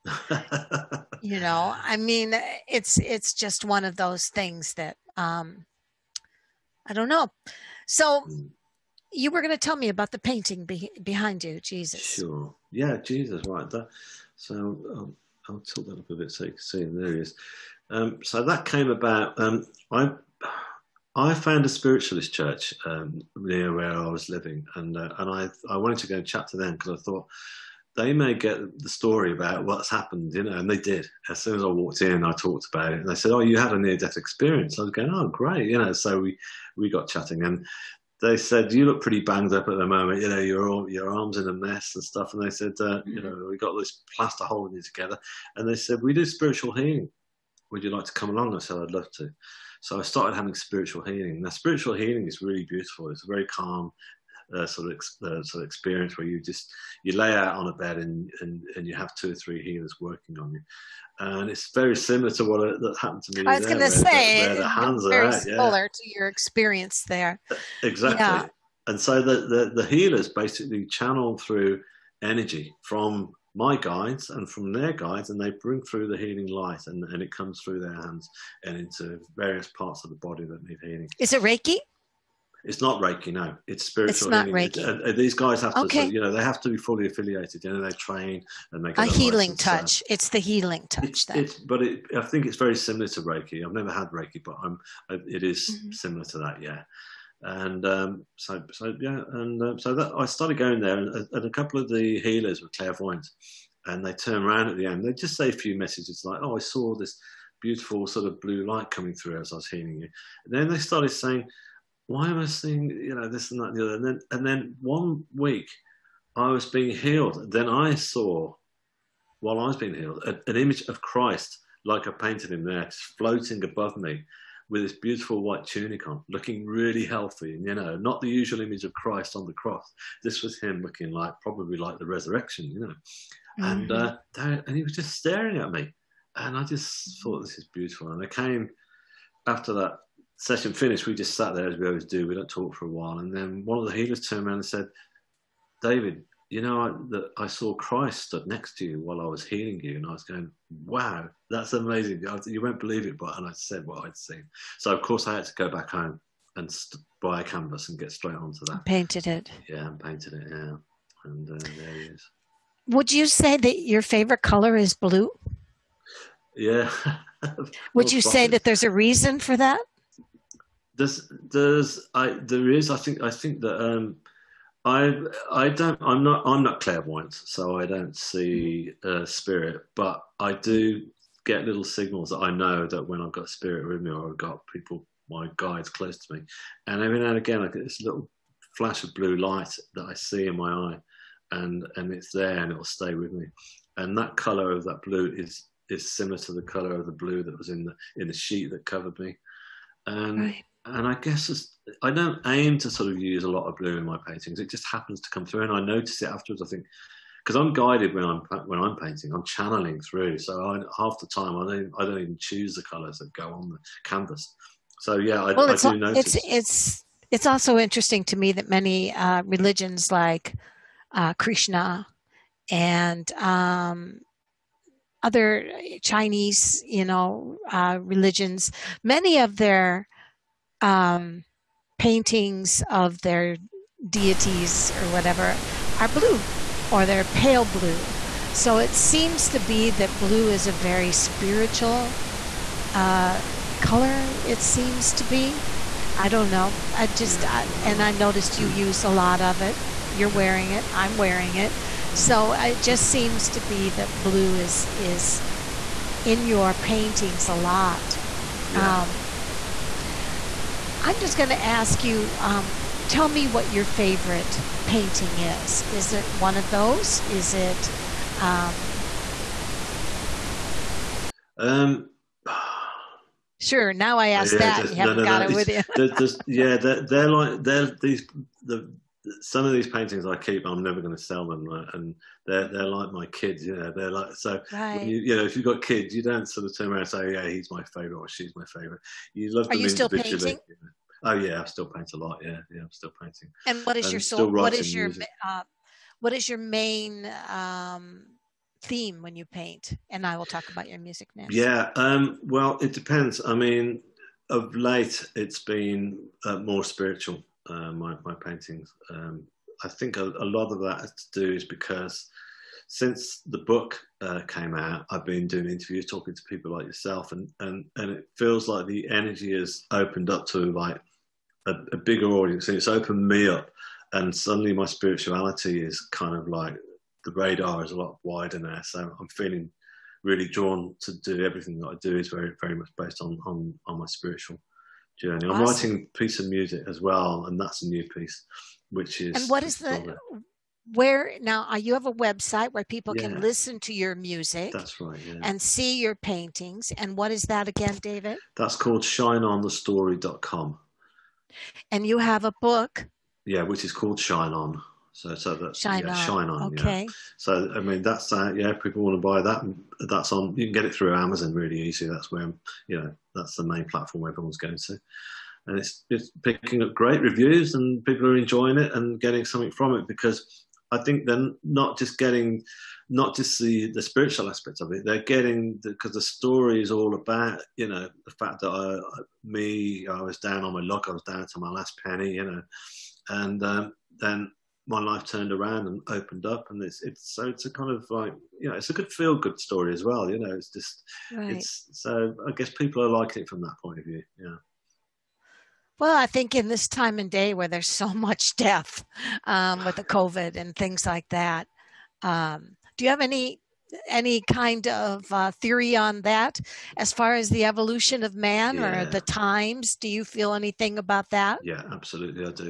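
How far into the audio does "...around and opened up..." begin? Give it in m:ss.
6:25.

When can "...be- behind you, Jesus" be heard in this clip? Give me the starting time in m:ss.
0:10.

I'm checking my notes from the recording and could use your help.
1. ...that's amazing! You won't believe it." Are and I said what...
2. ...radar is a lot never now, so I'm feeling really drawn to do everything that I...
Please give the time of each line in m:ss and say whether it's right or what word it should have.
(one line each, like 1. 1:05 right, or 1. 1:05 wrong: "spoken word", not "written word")
1. 2:31 wrong: "But", not "Are"
2. 5:27 wrong: "wider", not "never".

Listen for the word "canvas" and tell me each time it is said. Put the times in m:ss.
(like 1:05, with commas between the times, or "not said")
2:37, 3:34.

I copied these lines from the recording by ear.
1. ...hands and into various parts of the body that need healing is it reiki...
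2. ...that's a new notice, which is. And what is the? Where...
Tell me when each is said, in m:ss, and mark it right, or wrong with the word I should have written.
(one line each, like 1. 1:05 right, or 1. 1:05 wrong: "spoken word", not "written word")
1. 1:17 right
2. 5:37 wrong: "piece", not "notice".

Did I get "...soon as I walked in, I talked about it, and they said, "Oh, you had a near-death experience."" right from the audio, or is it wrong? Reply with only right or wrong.
right.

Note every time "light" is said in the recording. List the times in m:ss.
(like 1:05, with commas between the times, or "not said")
1:16, 1:48, 3:09.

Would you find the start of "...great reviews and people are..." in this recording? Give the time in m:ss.
6:06.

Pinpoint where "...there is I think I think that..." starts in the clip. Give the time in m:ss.
2:52.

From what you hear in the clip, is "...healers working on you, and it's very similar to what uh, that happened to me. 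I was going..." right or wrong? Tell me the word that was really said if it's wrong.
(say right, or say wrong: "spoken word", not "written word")
right.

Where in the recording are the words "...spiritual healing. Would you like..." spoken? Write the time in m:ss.
0:46.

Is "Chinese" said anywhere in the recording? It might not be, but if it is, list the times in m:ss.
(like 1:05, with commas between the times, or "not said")
3:46.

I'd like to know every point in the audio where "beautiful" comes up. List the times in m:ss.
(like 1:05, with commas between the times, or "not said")
0:52, 1:47, 2:05, 2:17.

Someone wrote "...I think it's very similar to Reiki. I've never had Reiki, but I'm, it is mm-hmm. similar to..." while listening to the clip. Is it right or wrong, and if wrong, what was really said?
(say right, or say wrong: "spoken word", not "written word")
right.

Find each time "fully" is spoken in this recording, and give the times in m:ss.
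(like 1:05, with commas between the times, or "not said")
1:26.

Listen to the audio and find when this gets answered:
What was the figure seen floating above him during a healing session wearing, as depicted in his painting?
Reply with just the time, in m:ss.
2:05.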